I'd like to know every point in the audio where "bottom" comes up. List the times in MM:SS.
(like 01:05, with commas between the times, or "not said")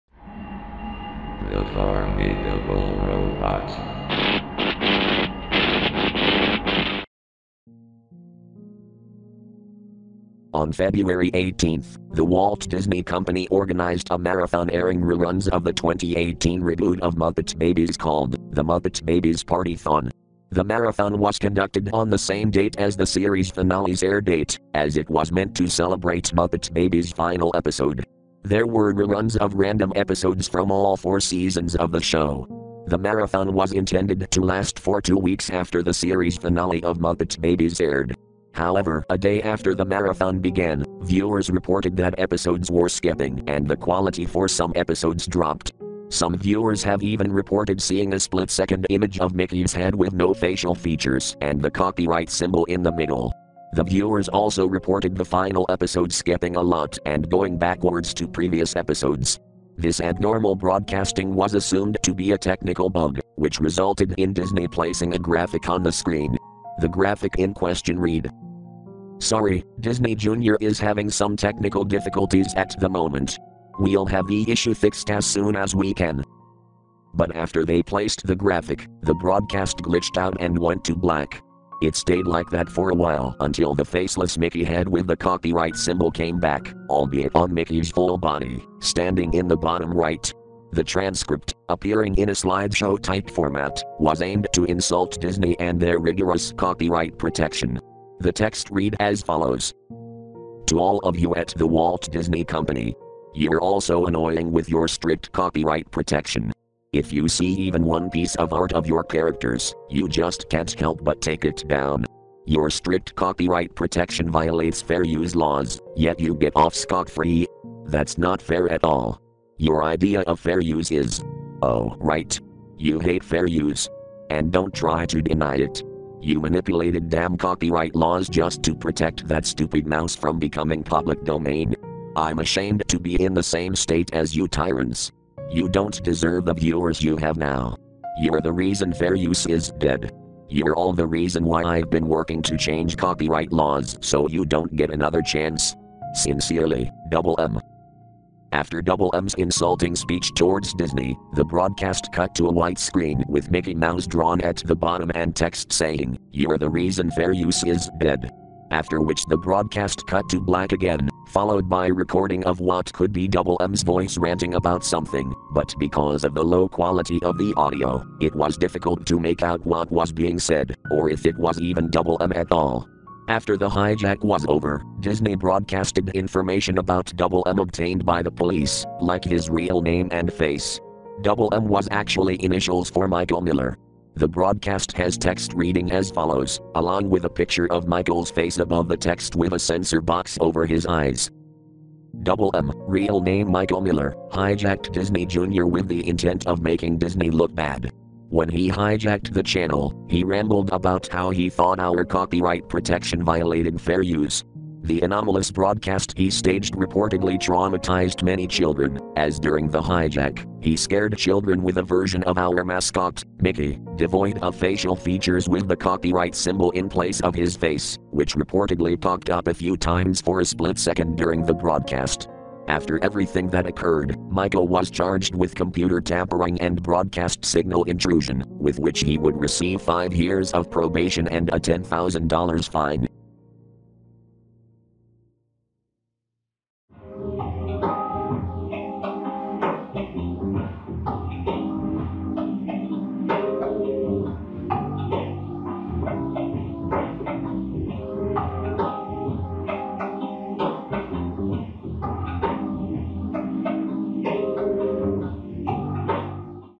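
01:29, 02:34.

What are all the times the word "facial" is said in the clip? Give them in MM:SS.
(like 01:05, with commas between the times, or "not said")
00:50, 03:34.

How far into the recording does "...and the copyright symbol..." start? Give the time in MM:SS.
00:51.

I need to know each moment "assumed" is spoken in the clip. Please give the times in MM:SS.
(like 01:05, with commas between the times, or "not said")
01:01.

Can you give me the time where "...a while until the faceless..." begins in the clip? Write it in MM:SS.
01:22.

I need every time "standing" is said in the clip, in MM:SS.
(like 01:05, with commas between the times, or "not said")
01:28.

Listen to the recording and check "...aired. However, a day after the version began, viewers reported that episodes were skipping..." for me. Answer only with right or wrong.
wrong.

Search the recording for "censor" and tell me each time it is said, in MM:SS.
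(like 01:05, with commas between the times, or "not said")
03:09.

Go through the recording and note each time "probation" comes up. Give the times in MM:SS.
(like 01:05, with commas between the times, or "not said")
03:50.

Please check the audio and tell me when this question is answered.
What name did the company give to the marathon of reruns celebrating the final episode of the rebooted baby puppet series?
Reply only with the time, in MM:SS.
00:18.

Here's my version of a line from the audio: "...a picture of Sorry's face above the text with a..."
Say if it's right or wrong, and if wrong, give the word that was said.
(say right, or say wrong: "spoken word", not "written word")
wrong: "Michael", not "Sorry".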